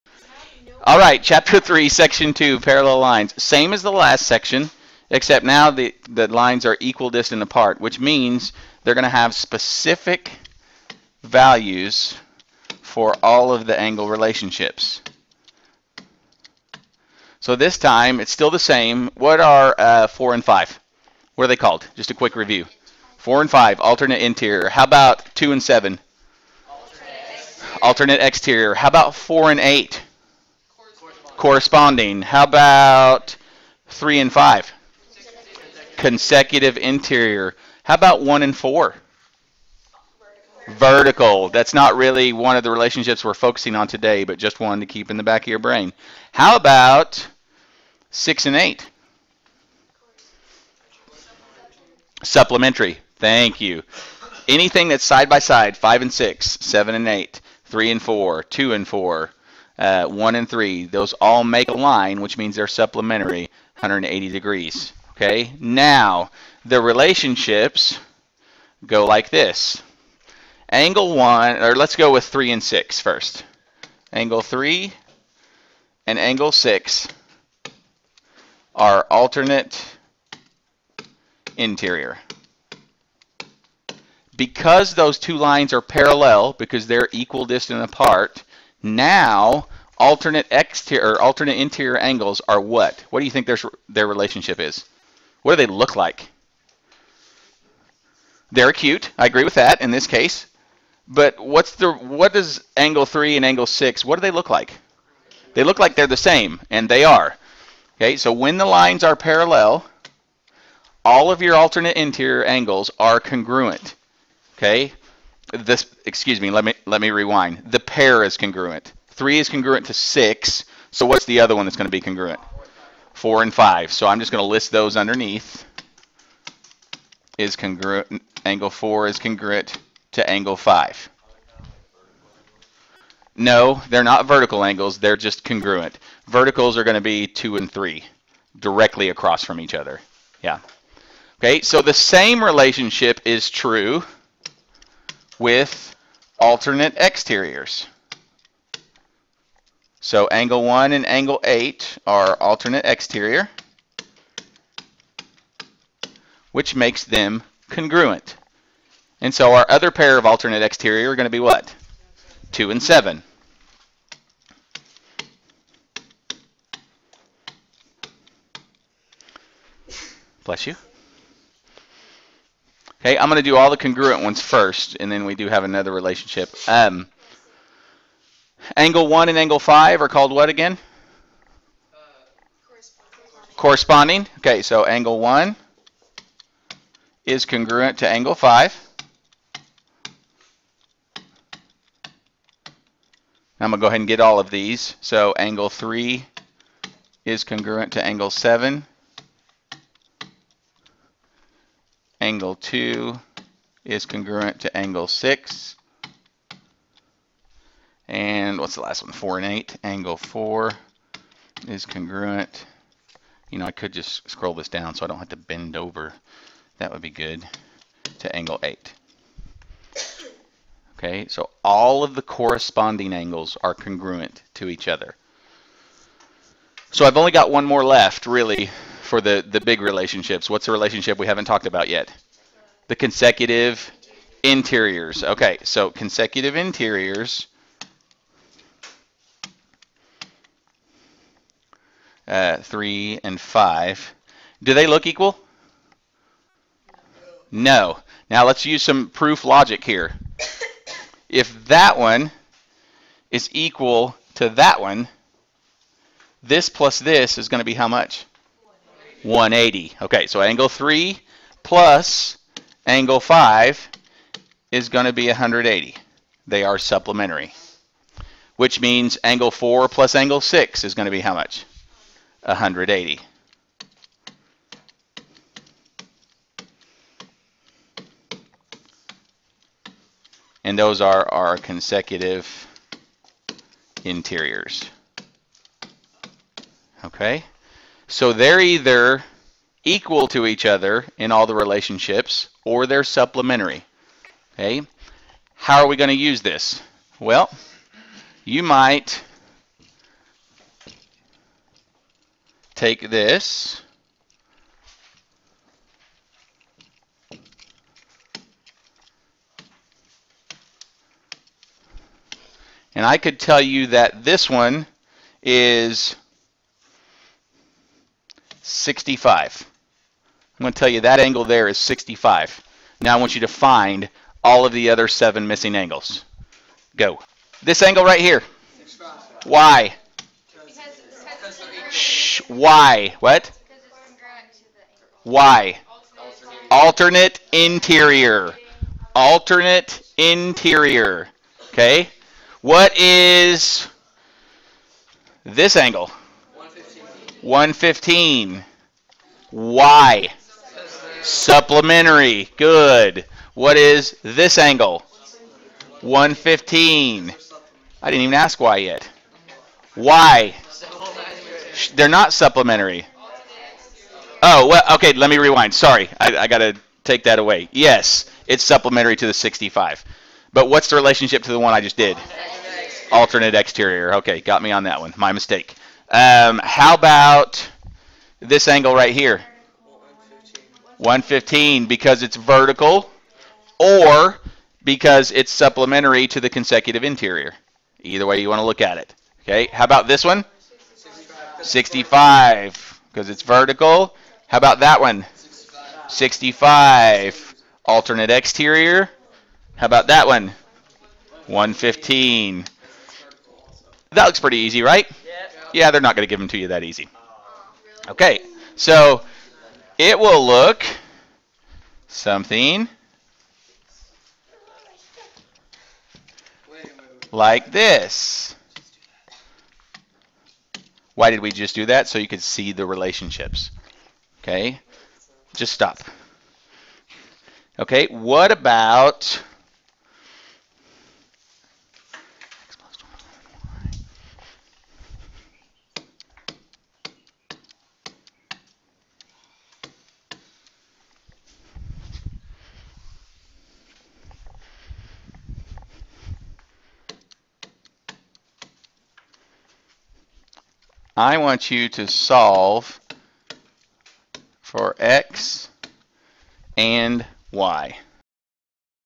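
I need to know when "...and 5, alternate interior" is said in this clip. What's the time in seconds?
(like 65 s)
23 s.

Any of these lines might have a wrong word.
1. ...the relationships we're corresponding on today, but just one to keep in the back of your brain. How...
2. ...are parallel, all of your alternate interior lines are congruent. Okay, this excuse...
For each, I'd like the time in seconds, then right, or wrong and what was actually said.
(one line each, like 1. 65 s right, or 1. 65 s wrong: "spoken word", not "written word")
1. 42 s wrong: "focusing", not "corresponding"
2. 109 s wrong: "angles", not "lines".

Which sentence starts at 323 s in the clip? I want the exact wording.
Now I want you to find all of the other seven missing angles.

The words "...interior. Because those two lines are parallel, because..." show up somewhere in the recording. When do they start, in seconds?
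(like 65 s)
81 s.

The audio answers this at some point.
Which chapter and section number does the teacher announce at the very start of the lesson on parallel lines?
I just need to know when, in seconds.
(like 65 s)
1 s.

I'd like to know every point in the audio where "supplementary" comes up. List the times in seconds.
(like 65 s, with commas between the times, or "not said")
52 s, 62 s, 266 s, 293 s, 351 s, 362 s, 368 s, 385 s.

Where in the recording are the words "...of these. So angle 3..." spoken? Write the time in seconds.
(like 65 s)
194 s.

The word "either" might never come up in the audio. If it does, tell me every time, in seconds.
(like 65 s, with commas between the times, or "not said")
288 s, 388 s.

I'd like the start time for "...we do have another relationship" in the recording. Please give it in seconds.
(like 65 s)
175 s.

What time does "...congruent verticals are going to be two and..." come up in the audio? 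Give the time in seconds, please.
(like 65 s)
135 s.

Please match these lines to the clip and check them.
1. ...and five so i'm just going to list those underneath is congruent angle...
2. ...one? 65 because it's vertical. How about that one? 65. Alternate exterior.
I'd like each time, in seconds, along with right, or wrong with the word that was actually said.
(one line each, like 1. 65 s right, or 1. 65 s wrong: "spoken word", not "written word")
1. 123 s right
2. 390 s right.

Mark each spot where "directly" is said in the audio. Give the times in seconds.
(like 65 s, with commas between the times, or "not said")
138 s.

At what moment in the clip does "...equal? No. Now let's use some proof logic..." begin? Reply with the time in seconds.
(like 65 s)
245 s.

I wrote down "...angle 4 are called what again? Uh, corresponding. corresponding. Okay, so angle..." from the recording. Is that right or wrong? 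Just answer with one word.
wrong.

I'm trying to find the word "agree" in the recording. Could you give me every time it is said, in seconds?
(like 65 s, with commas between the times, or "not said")
99 s.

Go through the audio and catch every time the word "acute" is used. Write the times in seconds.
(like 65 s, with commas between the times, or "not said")
98 s.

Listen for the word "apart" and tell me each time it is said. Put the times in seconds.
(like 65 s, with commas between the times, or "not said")
7 s, 87 s.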